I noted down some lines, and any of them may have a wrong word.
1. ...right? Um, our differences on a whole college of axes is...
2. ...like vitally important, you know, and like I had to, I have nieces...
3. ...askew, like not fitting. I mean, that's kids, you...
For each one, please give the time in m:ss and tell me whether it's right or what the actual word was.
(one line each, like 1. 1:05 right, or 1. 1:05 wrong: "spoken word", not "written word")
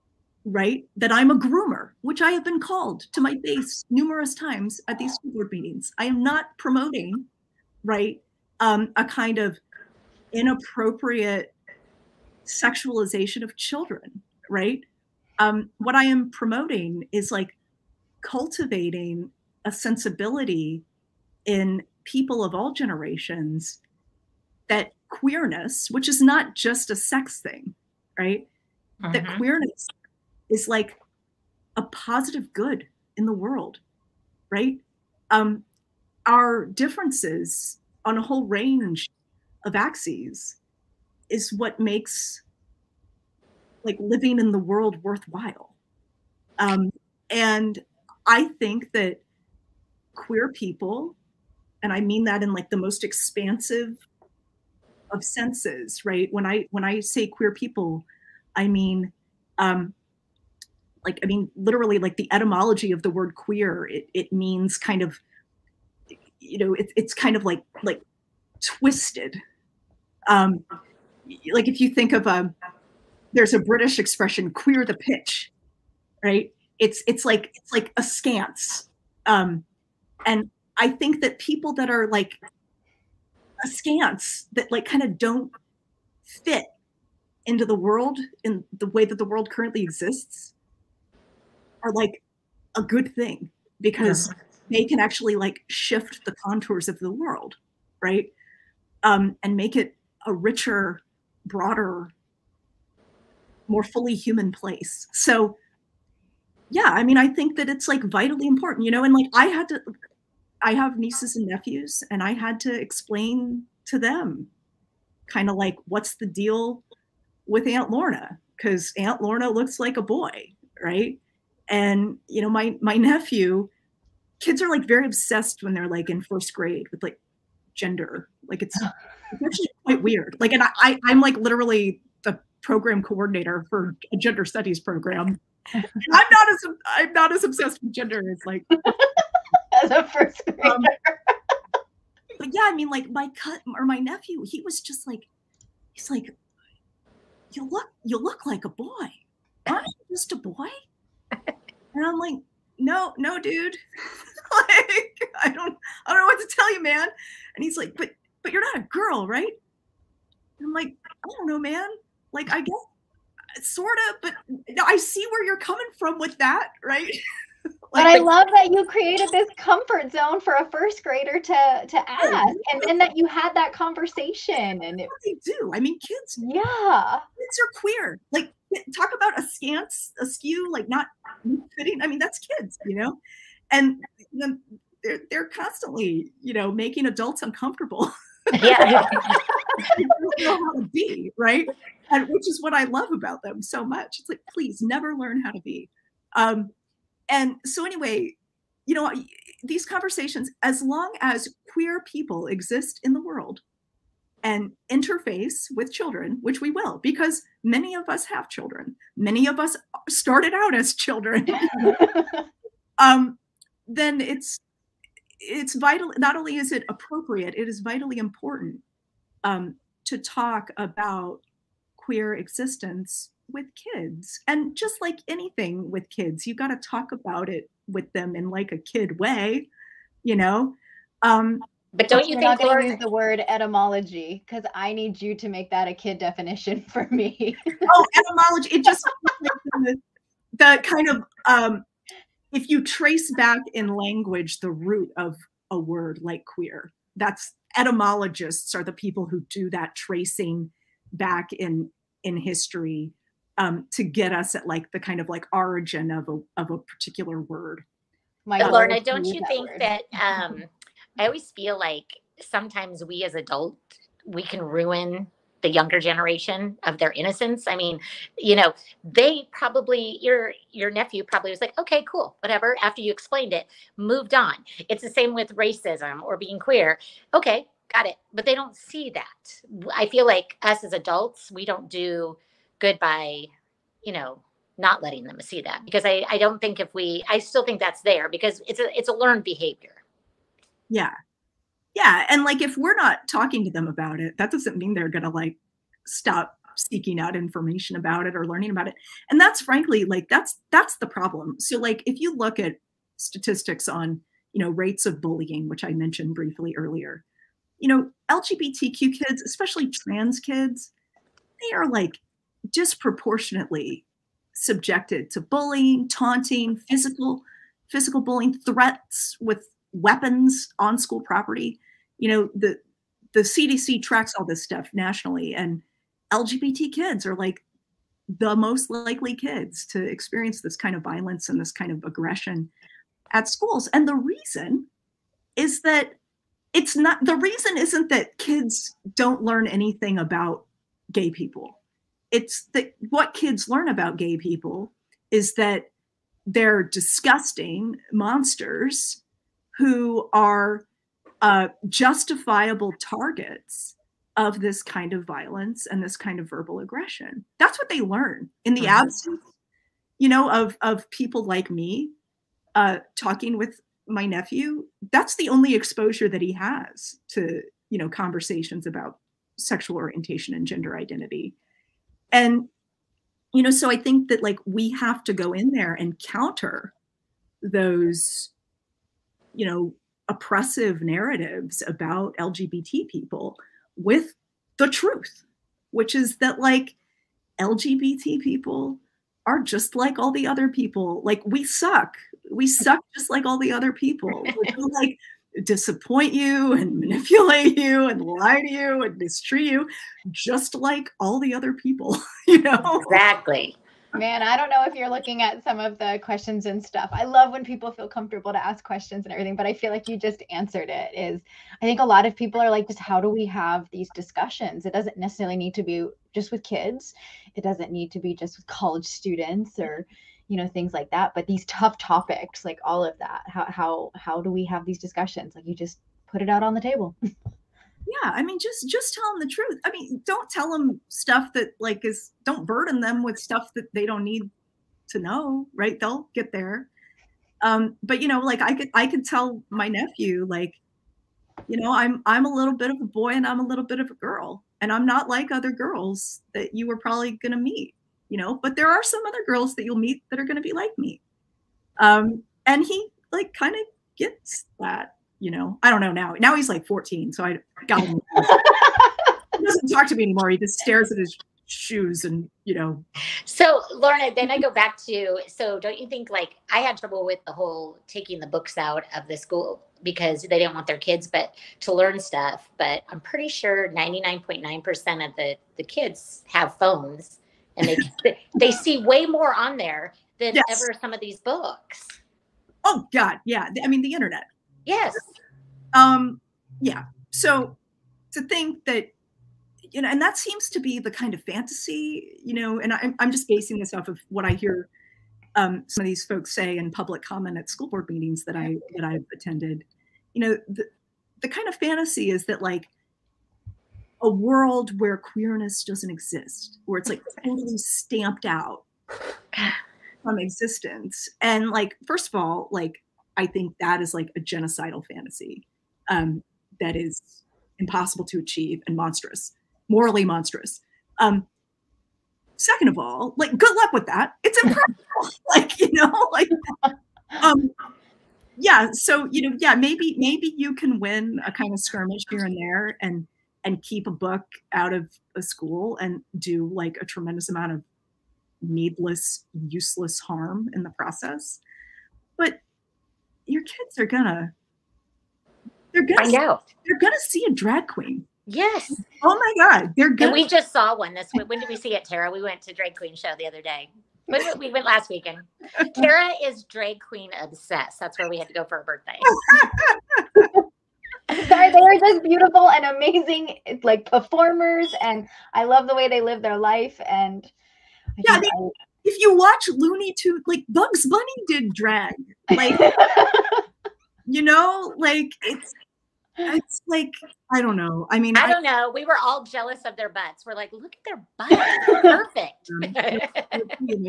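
1. 0:34 wrong: "range", not "college"
2. 1:47 right
3. 3:00 right.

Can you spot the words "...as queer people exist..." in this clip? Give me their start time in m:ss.
3:21.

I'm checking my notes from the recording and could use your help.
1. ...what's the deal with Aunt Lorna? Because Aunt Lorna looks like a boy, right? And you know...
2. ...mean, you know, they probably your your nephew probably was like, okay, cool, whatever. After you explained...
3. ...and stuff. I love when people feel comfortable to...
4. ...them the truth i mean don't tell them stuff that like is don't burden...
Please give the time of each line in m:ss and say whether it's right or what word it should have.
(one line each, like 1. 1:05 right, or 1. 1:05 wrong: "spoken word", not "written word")
1. 1:55 right
2. 4:27 right
3. 6:46 right
4. 7:09 right.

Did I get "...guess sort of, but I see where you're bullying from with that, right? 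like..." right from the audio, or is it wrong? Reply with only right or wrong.
wrong.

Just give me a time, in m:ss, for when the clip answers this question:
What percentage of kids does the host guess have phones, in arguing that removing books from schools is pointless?
7:53.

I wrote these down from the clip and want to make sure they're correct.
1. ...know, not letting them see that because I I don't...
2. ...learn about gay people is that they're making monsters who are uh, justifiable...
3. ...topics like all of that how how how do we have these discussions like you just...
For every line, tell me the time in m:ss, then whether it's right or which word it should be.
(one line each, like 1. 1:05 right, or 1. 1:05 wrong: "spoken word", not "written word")
1. 4:44 right
2. 5:43 wrong: "disgusting", not "making"
3. 7:01 right.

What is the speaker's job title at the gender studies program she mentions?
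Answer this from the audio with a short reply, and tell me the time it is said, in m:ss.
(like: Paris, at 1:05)
program coordinator, at 2:12.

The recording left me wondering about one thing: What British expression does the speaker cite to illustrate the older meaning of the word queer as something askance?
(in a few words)
queer the pitch.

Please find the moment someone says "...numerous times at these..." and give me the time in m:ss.
0:03.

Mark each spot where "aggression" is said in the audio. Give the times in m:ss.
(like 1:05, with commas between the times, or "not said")
5:32, 5:56.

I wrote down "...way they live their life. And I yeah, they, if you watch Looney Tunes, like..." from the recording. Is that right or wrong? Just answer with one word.
right.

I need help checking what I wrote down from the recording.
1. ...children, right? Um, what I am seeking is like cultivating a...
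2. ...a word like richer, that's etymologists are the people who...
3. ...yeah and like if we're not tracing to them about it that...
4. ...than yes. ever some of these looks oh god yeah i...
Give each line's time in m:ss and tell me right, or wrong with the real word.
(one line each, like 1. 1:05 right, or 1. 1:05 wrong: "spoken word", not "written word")
1. 0:13 wrong: "promoting", not "seeking"
2. 4:05 wrong: "queer", not "richer"
3. 4:51 wrong: "talking", not "tracing"
4. 8:00 wrong: "books", not "looks".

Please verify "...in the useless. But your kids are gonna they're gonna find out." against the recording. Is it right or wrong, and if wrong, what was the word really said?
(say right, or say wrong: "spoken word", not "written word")
wrong: "process", not "useless".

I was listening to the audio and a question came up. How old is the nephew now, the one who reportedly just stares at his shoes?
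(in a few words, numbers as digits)
14.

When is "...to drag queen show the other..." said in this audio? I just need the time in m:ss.
9:12.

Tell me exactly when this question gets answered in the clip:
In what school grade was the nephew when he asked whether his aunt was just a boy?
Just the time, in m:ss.
2:06.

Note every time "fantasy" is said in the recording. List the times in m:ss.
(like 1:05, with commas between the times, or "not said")
8:11, 8:21, 8:35.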